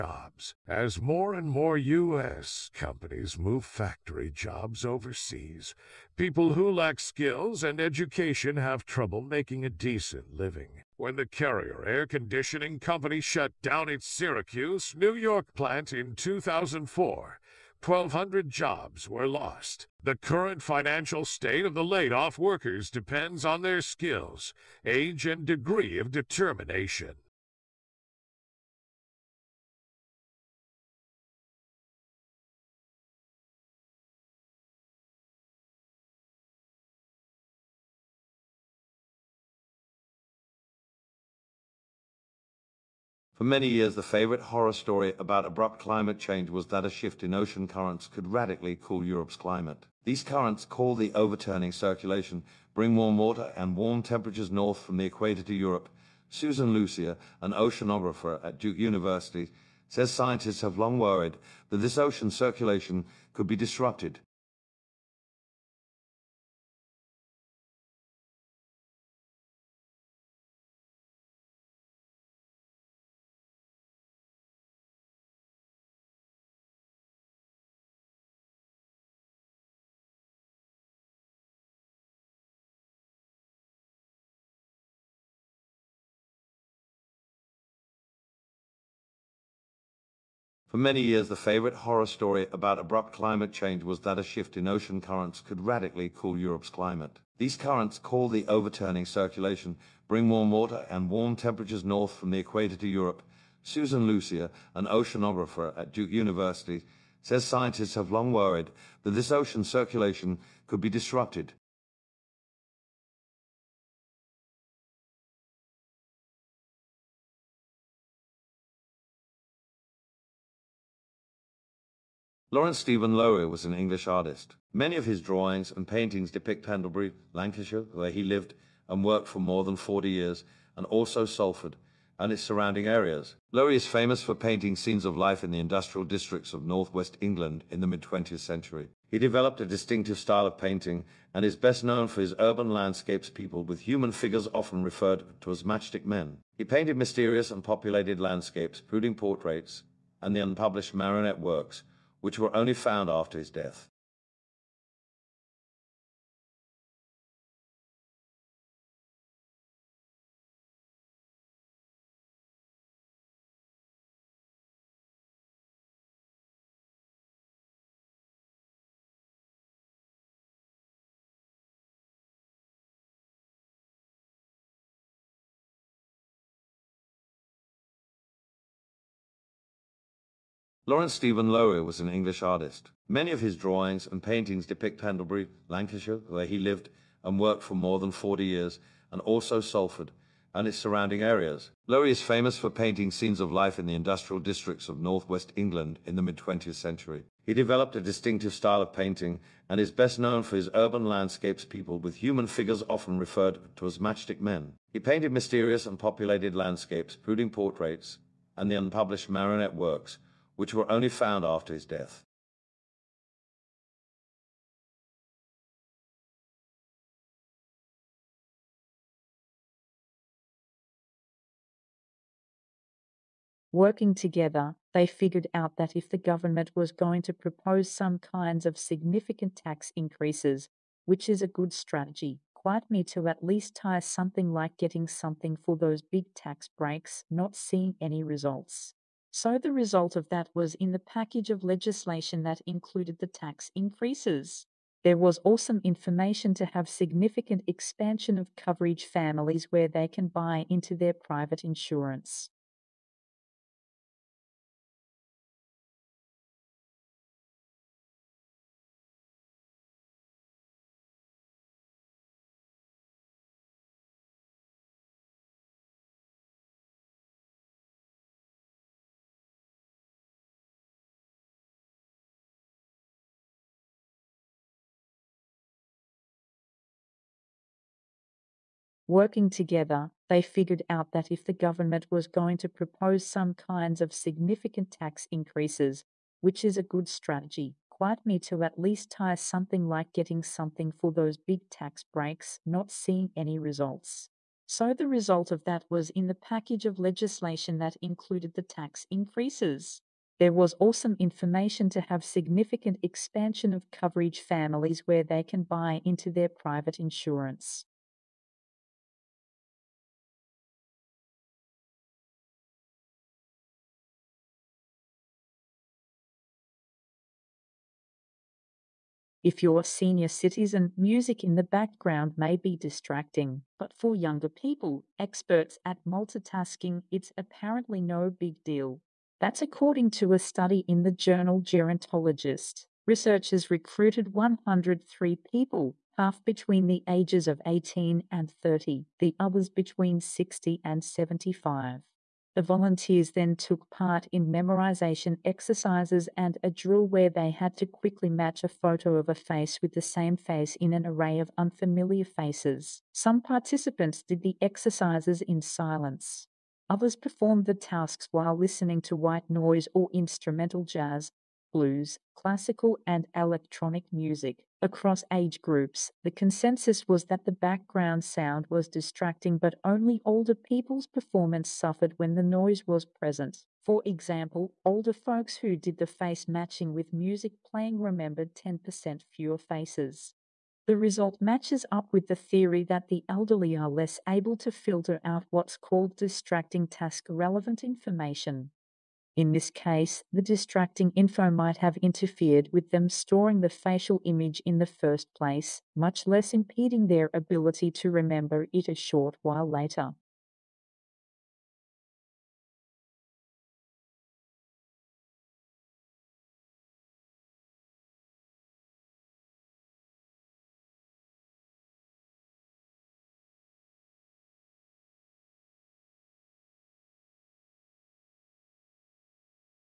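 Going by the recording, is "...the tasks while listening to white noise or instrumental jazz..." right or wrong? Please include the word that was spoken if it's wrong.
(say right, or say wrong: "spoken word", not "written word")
right.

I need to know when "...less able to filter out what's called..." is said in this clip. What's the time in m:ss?
6:23.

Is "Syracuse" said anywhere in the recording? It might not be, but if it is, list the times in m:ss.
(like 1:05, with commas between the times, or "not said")
0:14.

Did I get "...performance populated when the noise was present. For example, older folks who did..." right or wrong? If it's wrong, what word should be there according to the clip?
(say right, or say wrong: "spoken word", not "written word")
wrong: "suffered", not "populated".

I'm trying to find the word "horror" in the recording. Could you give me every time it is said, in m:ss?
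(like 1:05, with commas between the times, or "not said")
0:44, 1:31.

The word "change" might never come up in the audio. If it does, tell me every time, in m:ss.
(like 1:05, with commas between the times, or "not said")
0:46, 1:33.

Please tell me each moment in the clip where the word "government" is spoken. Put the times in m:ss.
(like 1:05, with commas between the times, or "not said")
3:46, 4:41.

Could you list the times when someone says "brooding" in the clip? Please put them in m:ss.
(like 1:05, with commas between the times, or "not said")
2:28, 3:27.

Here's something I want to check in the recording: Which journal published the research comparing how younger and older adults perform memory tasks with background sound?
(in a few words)
Gerontologist.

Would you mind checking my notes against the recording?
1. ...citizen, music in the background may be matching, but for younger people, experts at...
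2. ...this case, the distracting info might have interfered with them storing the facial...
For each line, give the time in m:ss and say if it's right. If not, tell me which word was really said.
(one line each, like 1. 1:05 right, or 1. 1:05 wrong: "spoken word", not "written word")
1. 5:20 wrong: "distracting", not "matching"
2. 6:29 right.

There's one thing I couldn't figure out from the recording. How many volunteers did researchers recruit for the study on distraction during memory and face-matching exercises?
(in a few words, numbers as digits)
103.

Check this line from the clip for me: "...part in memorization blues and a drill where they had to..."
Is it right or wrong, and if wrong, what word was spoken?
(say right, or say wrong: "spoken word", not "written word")
wrong: "exercises", not "blues".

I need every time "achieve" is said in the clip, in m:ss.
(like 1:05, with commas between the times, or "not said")
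not said.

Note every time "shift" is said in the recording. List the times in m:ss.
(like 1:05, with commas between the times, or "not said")
0:46, 1:34.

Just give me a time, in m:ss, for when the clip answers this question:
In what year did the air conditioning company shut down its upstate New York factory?
0:16.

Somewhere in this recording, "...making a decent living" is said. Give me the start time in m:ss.
0:09.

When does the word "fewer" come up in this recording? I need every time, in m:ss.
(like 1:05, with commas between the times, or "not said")
6:19.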